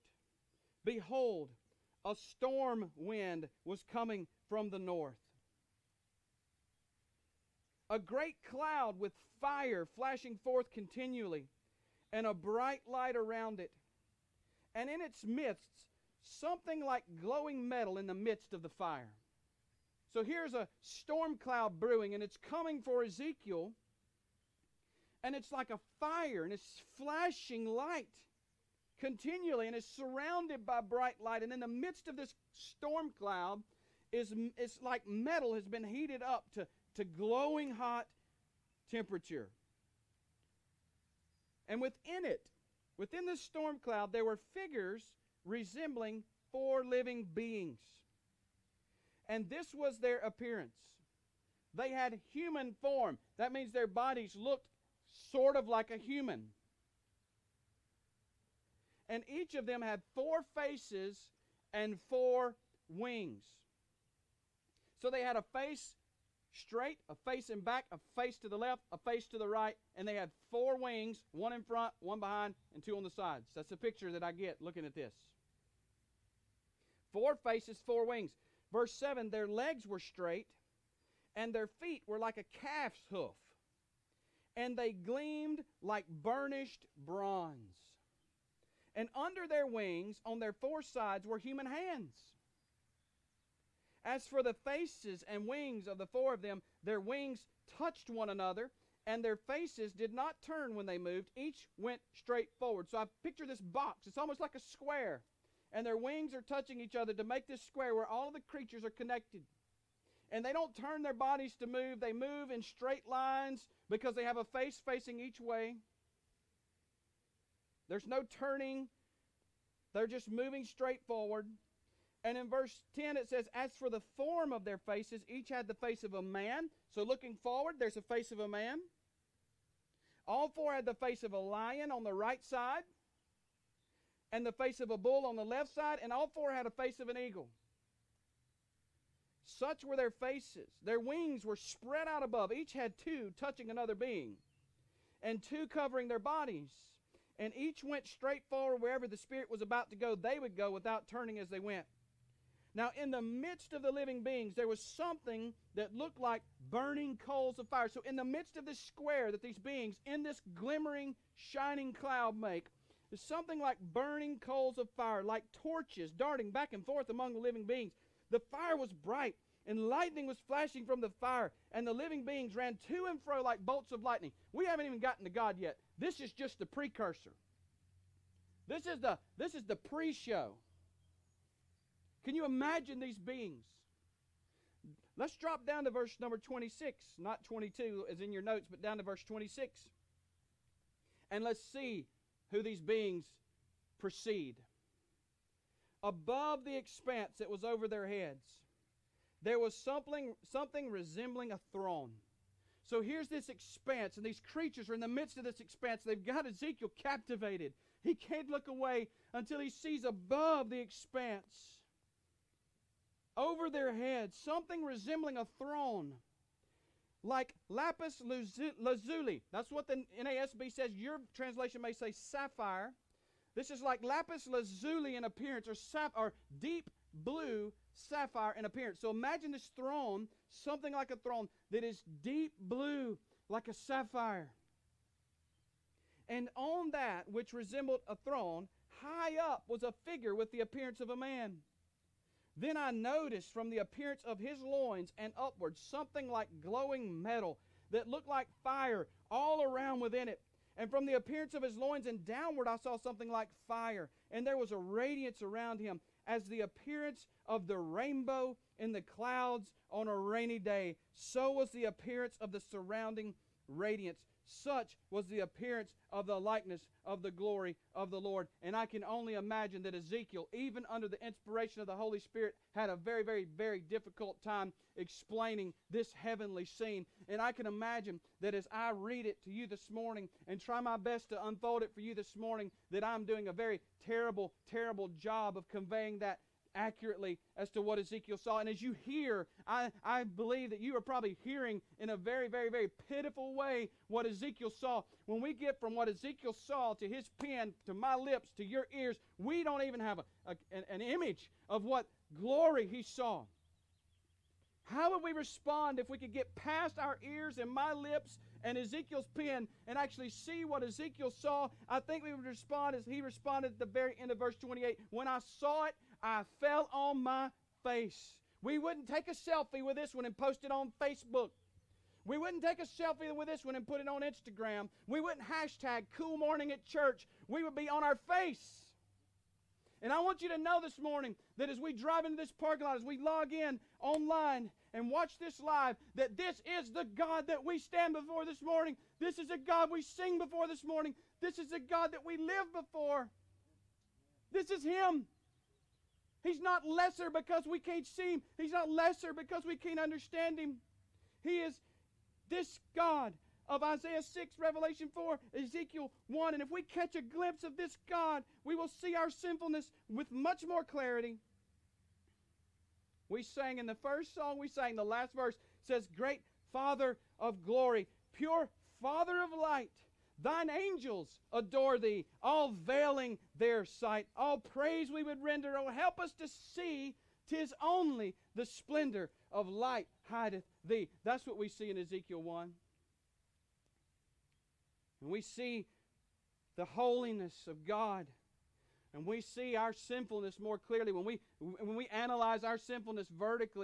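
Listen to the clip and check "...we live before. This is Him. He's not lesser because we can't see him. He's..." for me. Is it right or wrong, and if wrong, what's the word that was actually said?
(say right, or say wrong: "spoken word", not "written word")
right.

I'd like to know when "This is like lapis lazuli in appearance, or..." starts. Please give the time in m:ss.
3:43.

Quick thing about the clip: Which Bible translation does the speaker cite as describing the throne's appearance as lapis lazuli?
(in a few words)
NASB.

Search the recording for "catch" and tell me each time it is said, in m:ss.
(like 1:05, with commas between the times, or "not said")
5:56.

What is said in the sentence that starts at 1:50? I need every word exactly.
And they don't turn their bodies to move, they move in straight lines because they have a face facing each way.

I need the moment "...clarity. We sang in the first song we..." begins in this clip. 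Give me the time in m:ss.
6:00.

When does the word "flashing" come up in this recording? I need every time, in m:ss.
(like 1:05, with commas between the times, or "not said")
0:09, 0:26, 2:50.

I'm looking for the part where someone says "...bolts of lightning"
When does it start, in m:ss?
2:53.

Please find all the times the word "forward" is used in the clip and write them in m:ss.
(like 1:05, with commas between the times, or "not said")
1:42, 2:01, 2:07, 2:28.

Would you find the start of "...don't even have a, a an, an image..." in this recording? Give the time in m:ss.
4:59.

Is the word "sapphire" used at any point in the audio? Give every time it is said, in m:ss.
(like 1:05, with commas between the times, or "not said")
3:42, 3:47, 3:53.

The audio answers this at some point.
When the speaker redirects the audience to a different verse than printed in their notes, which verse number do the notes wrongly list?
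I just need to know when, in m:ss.
3:07.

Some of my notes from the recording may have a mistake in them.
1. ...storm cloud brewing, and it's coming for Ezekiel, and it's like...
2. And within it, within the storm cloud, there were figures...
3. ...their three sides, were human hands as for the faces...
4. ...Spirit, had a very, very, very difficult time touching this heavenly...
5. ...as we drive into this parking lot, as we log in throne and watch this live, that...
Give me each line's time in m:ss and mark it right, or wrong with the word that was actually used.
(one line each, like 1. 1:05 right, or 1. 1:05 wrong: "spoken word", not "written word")
1. 0:20 right
2. 0:41 right
3. 1:30 wrong: "four", not "three"
4. 4:32 wrong: "explaining", not "touching"
5. 5:31 wrong: "online", not "throne".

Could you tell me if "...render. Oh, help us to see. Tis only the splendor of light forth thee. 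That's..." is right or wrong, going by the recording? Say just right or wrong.
wrong.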